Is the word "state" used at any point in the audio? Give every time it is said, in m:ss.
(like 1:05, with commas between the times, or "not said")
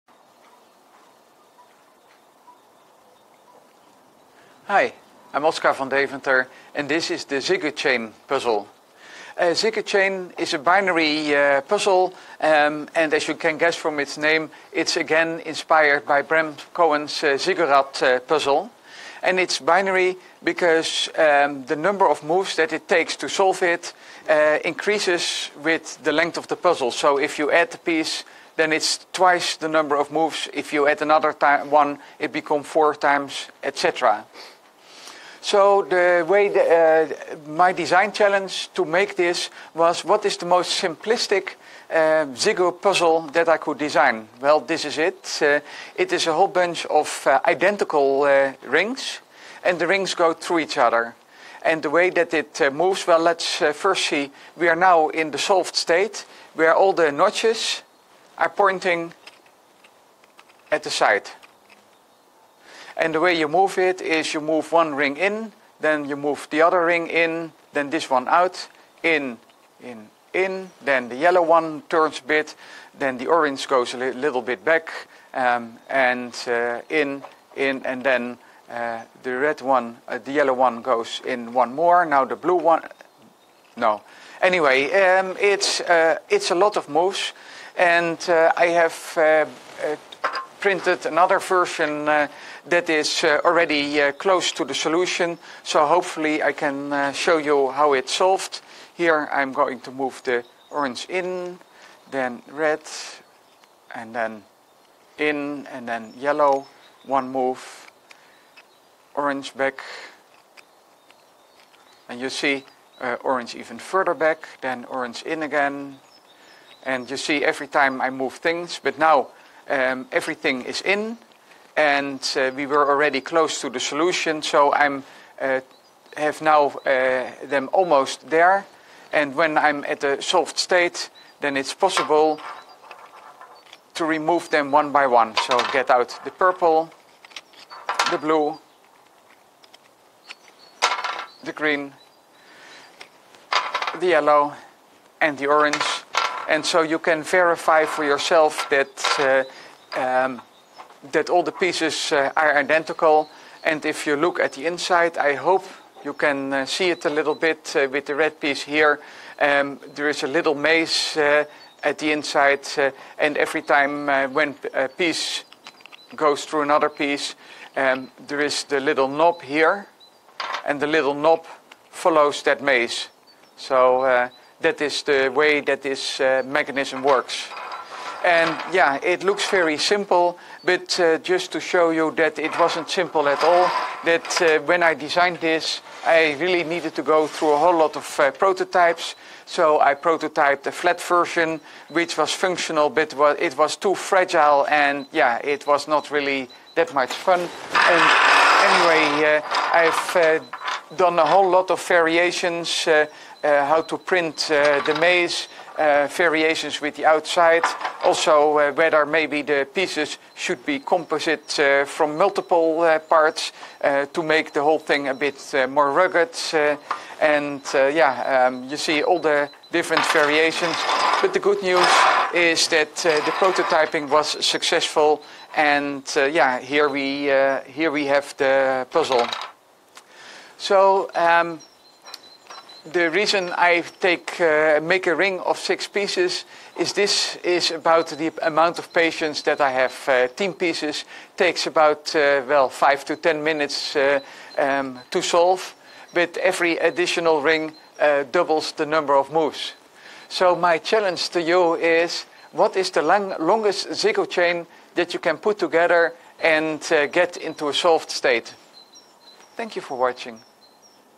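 0:55, 2:10, 4:18.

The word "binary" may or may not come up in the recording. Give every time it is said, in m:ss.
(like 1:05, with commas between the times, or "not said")
0:10, 0:19.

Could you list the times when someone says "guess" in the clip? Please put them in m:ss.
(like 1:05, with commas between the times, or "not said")
0:13.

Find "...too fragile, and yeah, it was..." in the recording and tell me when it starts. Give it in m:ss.
3:13.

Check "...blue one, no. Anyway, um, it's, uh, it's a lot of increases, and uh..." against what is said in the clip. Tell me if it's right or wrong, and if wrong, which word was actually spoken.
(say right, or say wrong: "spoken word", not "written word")
wrong: "moves", not "increases".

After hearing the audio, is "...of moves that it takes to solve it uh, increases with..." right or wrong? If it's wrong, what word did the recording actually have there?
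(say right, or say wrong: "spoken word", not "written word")
right.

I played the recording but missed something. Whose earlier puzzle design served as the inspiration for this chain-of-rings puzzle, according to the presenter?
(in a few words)
Bram Cohen.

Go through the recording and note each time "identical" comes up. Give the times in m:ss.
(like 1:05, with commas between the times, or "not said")
0:47, 2:32.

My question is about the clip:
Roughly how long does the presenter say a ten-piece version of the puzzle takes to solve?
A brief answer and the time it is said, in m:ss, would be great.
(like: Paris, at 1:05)
5 to 10 minutes, at 4:02.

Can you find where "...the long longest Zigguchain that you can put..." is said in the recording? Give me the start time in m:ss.
4:12.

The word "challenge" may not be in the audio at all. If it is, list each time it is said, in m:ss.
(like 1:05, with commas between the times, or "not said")
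0:38, 4:10.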